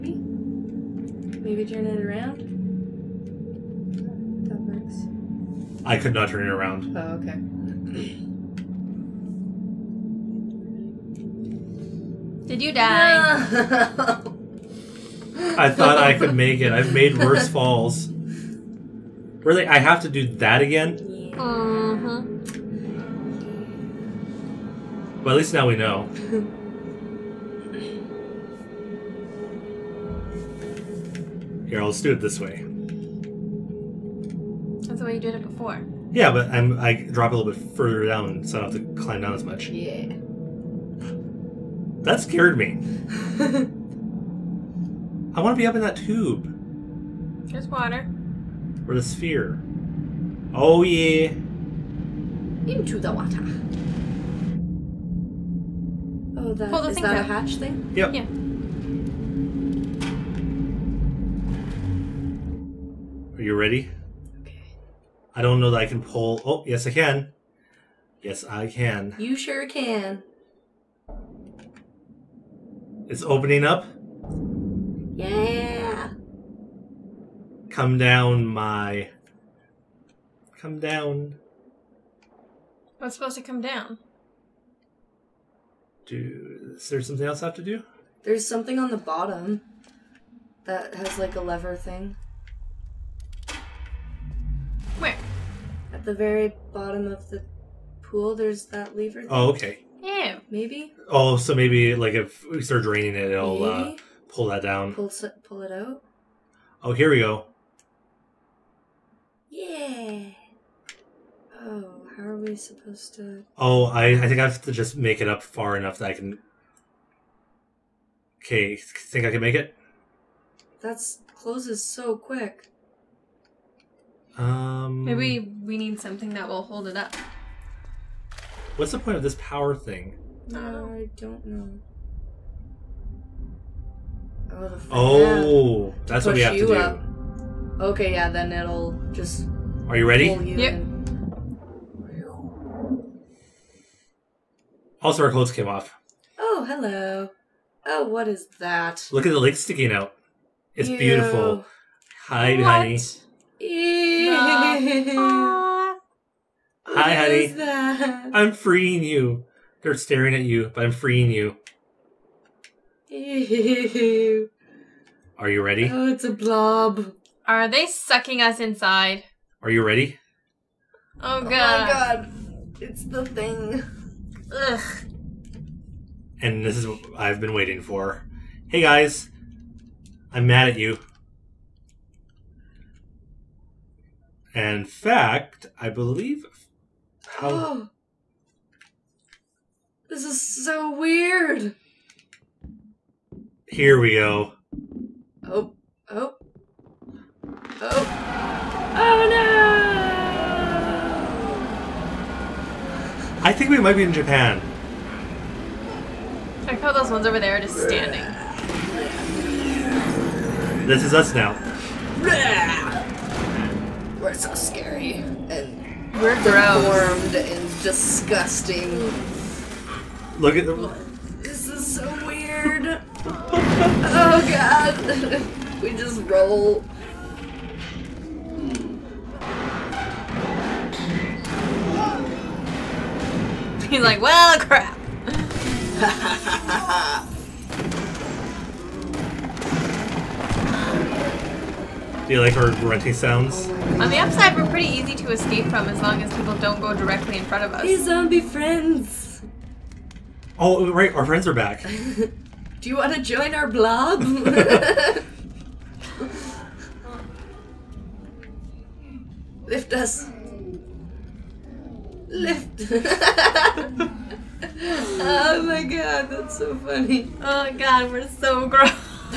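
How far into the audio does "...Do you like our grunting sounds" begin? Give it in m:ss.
4:02.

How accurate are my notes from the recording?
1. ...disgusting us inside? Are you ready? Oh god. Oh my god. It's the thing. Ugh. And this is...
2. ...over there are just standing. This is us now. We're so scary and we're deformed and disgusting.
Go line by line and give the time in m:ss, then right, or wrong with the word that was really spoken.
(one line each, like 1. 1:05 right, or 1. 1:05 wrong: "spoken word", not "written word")
1. 2:47 wrong: "sucking", not "disgusting"
2. 3:27 right.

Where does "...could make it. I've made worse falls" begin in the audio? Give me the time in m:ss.
0:16.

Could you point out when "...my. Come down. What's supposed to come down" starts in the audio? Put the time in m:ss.
1:18.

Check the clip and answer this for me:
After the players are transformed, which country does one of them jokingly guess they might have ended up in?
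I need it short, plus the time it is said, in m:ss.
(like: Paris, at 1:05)
Japan, at 3:24.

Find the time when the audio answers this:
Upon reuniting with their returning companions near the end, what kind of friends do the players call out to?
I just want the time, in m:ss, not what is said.
4:07.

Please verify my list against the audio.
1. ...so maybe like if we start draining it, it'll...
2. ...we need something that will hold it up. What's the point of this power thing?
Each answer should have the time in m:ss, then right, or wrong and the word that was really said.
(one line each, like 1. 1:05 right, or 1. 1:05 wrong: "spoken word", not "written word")
1. 1:41 right
2. 2:05 right.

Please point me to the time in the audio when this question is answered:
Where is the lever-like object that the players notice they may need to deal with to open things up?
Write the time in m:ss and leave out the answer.
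1:35.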